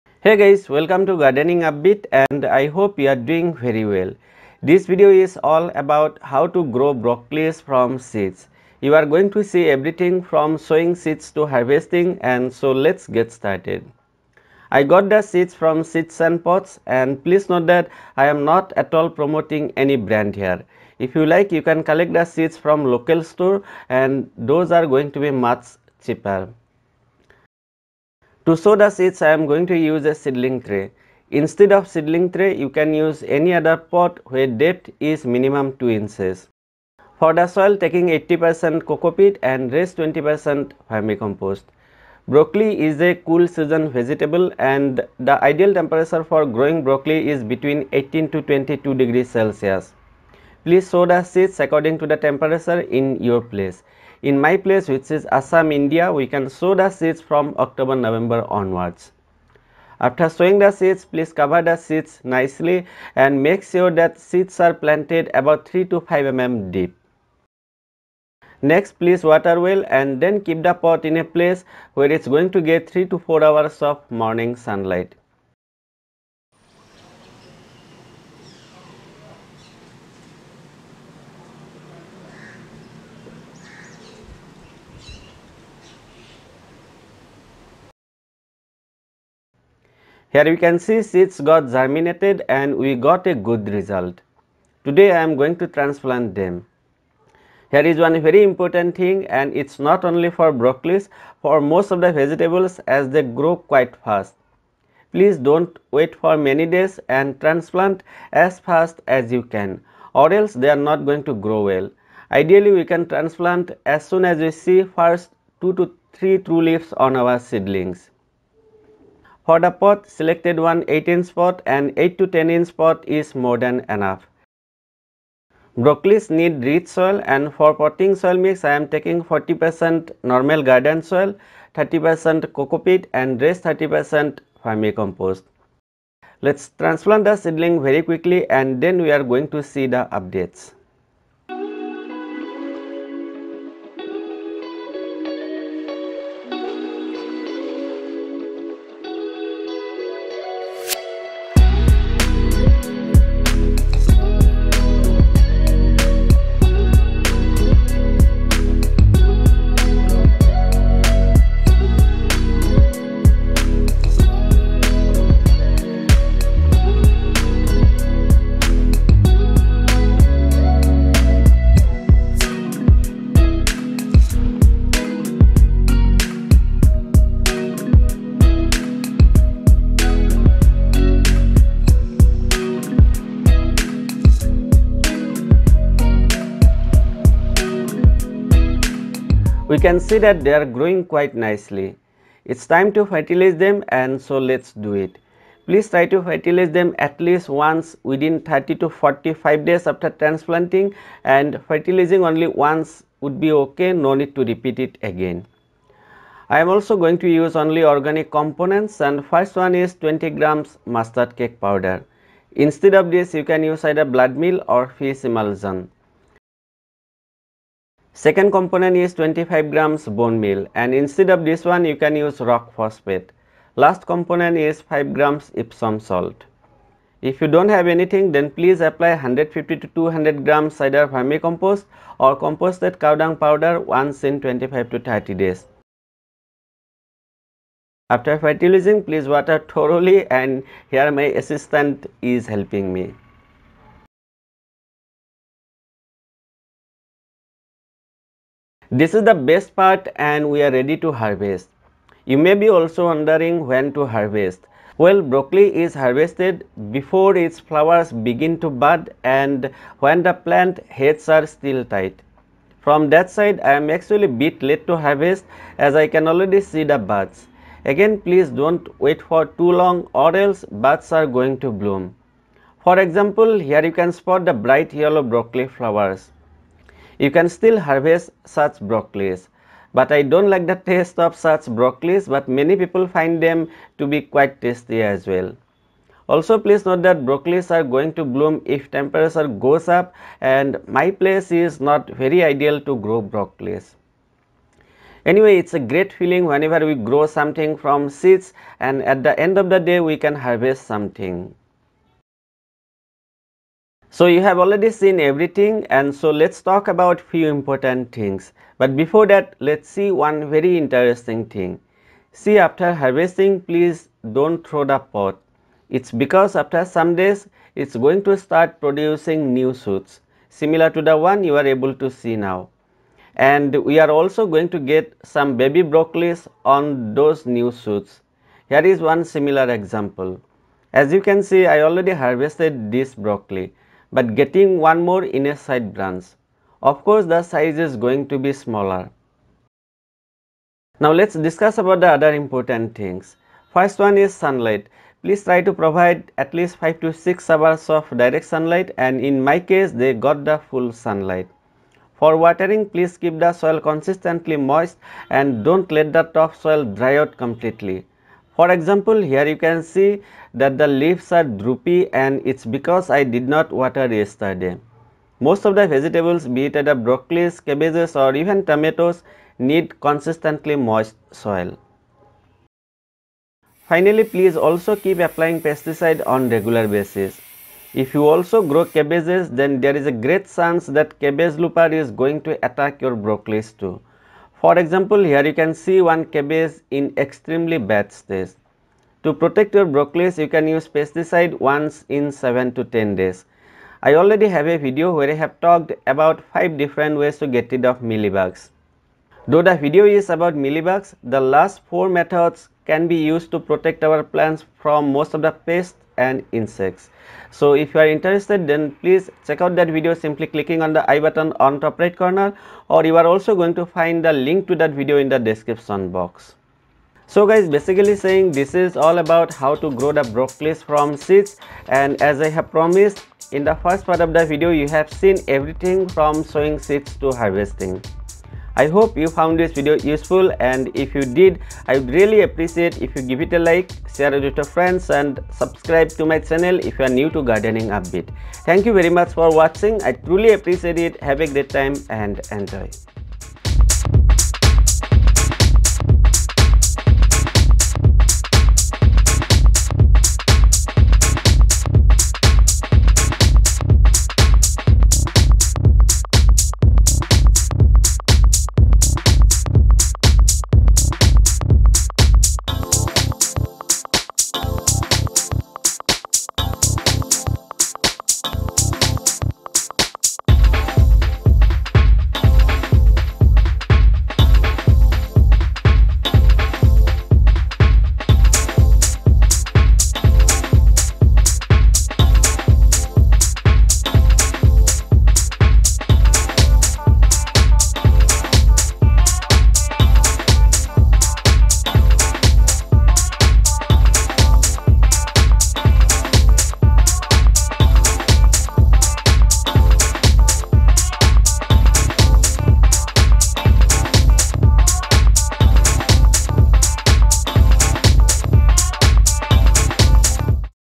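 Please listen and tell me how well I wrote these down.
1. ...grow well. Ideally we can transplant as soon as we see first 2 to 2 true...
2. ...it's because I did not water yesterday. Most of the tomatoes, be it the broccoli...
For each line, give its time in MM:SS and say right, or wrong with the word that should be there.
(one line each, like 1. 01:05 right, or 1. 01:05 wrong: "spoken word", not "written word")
1. 01:51 wrong: "3", not "2"
2. 06:02 wrong: "vegetables", not "tomatoes".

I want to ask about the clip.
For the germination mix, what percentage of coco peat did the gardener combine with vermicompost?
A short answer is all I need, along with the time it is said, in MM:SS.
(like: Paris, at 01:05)
80%, at 00:38.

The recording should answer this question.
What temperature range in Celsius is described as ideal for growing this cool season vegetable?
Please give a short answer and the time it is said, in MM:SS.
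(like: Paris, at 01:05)
18 to 22 degrees, at 00:47.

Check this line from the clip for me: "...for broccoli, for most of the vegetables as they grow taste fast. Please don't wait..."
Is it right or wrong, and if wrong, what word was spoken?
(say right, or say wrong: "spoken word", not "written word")
wrong: "quite", not "taste".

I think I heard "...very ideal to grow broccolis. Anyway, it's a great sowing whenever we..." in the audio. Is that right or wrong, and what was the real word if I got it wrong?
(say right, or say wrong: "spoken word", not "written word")
wrong: "feeling", not "sowing".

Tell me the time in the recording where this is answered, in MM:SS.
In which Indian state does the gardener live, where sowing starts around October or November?
00:55.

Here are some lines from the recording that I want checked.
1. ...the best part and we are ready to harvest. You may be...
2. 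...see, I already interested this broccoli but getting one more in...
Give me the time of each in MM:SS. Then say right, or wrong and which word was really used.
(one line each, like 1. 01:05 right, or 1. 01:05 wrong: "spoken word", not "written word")
1. 04:09 right
2. 05:31 wrong: "harvested", not "interested".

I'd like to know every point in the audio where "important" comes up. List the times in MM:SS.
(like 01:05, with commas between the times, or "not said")
01:38, 05:07, 05:42.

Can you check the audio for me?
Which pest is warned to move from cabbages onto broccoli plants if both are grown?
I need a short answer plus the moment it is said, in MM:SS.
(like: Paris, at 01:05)
cabbage looper, at 06:21.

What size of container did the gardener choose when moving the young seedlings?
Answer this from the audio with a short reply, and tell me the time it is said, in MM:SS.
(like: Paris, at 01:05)
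8 inch, at 02:00.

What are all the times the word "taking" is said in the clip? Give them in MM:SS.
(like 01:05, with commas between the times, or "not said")
00:37, 02:08.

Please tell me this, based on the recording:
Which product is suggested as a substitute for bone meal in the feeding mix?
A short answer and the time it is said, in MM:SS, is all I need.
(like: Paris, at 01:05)
rock phosphate, at 03:42.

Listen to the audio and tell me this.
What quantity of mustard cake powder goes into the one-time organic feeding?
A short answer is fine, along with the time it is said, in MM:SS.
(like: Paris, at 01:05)
20 grams, at 03:29.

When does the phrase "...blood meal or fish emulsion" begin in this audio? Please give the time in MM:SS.
03:34.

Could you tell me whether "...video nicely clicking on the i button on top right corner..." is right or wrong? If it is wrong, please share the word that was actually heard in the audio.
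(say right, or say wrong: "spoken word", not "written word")
wrong: "simply", not "nicely".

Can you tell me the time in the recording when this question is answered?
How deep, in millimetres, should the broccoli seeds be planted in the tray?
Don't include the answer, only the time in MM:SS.
01:05.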